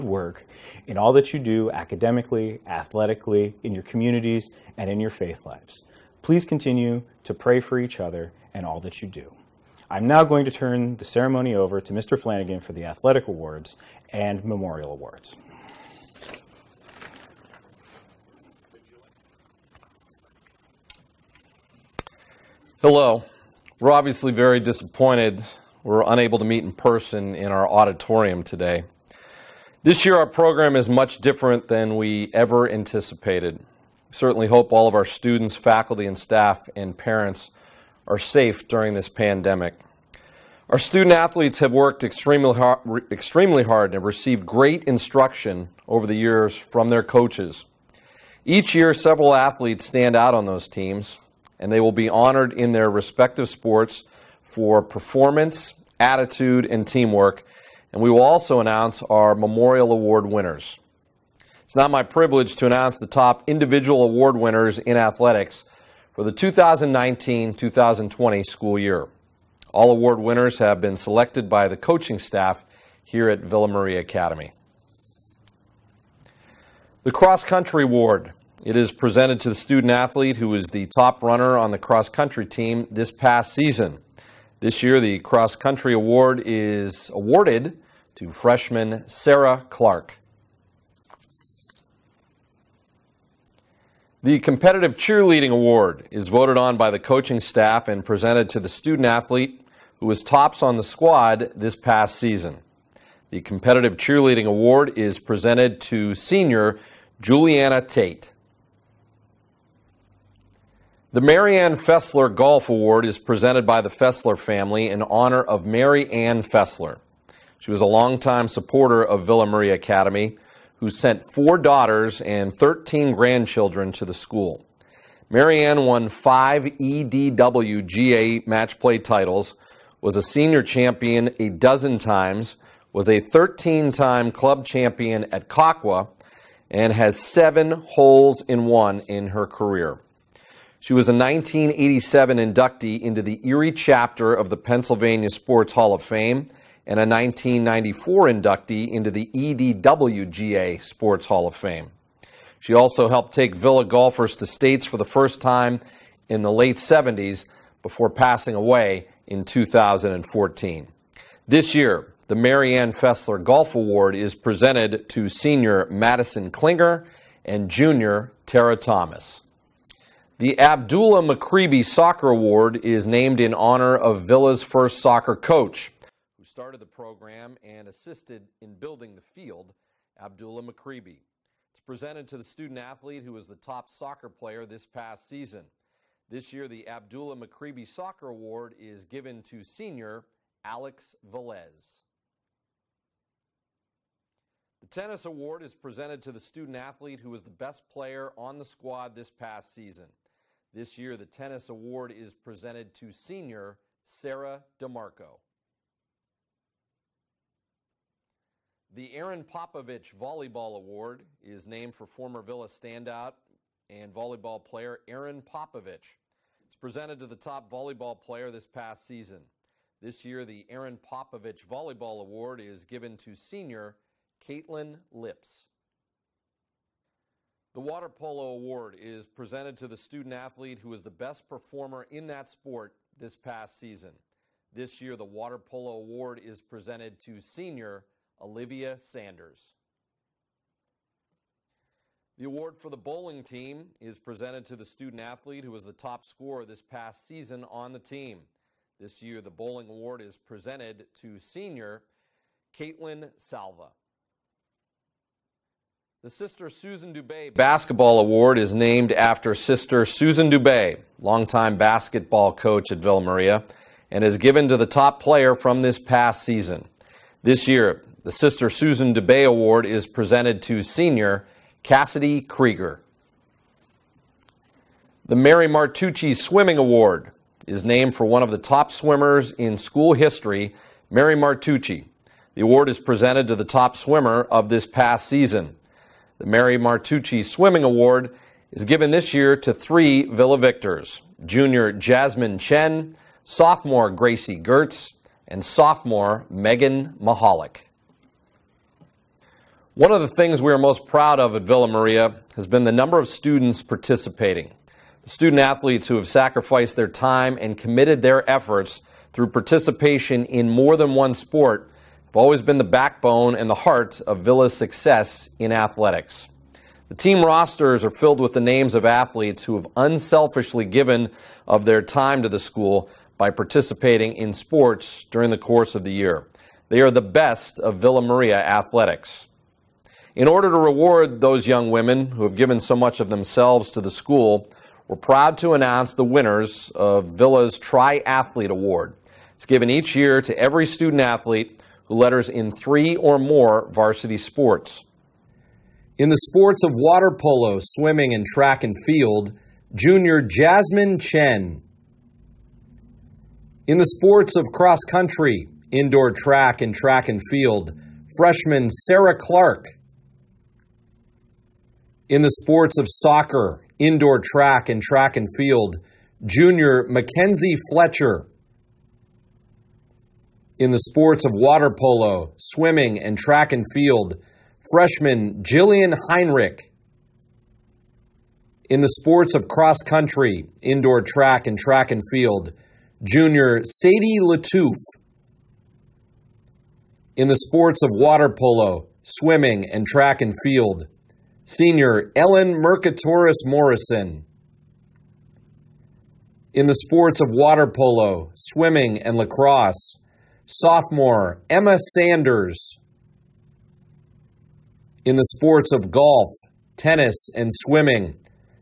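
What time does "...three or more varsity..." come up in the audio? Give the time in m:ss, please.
5:42.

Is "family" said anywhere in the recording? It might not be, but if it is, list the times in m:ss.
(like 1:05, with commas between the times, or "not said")
1:54.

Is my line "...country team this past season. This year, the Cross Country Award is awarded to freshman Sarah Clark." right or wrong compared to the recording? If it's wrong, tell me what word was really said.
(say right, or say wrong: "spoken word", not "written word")
right.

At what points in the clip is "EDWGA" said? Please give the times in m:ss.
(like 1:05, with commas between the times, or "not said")
2:06, 2:29.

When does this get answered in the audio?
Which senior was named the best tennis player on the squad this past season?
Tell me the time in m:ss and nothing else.
3:24.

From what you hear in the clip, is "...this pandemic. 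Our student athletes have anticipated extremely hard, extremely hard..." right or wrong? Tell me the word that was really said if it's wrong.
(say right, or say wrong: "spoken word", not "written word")
wrong: "worked", not "anticipated".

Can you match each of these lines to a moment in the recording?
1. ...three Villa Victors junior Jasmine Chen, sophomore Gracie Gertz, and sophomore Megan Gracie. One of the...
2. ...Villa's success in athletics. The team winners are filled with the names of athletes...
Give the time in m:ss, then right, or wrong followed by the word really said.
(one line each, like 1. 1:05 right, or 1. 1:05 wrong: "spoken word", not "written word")
1. 4:49 wrong: "Mahalik", not "Gracie"
2. 5:14 wrong: "rosters", not "winners".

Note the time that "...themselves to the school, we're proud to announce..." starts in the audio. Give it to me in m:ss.
5:33.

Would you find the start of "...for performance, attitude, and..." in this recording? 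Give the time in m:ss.
0:54.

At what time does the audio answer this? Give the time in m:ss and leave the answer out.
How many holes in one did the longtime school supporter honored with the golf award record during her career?
2:17.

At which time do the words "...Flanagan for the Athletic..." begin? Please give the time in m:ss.
0:12.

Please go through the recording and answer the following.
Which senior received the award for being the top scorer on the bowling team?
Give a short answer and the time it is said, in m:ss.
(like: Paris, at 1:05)
Caitlin Salva, at 4:12.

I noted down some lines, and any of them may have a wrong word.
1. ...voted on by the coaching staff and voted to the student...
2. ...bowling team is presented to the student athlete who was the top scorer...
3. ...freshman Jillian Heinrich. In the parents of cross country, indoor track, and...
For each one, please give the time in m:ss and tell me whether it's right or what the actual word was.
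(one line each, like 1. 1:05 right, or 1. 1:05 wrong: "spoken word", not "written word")
1. 1:36 wrong: "presented", not "voted"
2. 4:02 right
3. 6:14 wrong: "sports", not "parents".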